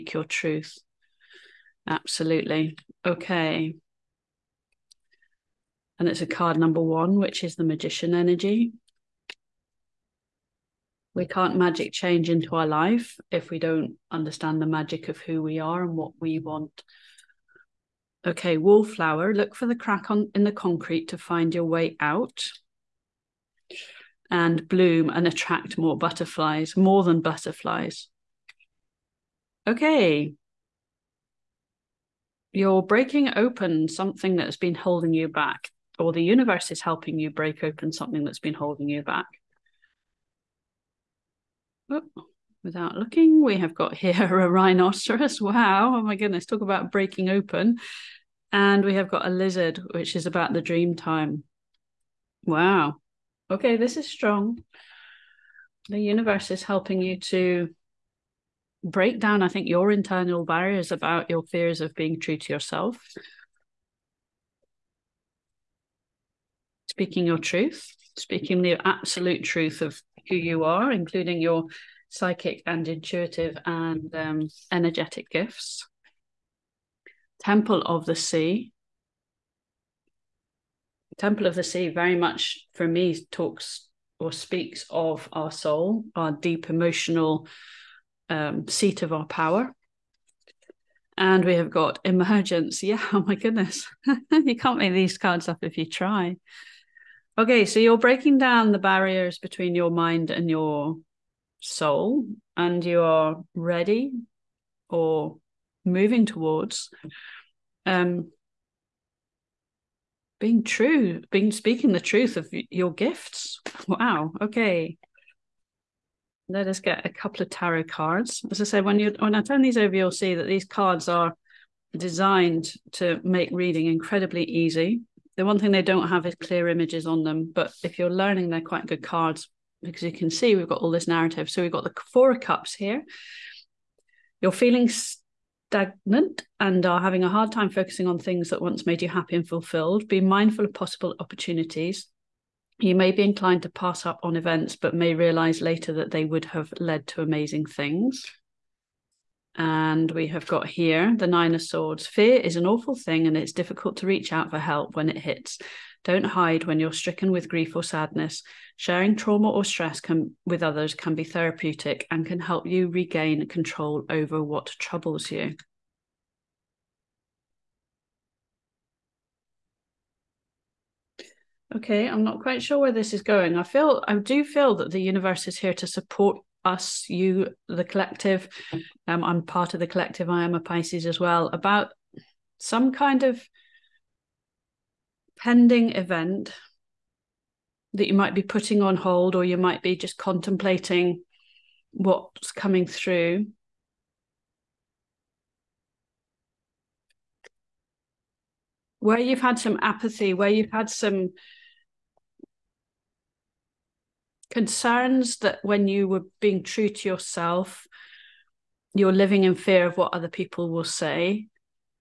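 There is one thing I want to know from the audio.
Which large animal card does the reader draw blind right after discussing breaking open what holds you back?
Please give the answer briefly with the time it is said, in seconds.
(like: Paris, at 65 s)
Rhinoceros, at 44 s.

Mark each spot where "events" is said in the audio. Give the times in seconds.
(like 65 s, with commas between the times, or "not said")
144 s, 185 s.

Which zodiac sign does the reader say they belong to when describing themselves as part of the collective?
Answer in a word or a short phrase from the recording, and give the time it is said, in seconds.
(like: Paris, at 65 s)
Pisces, at 180 s.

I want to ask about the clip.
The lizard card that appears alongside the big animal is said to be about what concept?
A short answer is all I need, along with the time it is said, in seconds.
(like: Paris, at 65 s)
The dream time, at 50 s.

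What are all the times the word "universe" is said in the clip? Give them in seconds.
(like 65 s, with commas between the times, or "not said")
36 s, 55 s, 175 s.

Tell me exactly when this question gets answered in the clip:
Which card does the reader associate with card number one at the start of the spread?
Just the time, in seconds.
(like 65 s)
7 s.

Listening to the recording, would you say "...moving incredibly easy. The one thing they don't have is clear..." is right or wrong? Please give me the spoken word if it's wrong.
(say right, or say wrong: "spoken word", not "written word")
wrong: "reading", not "moving".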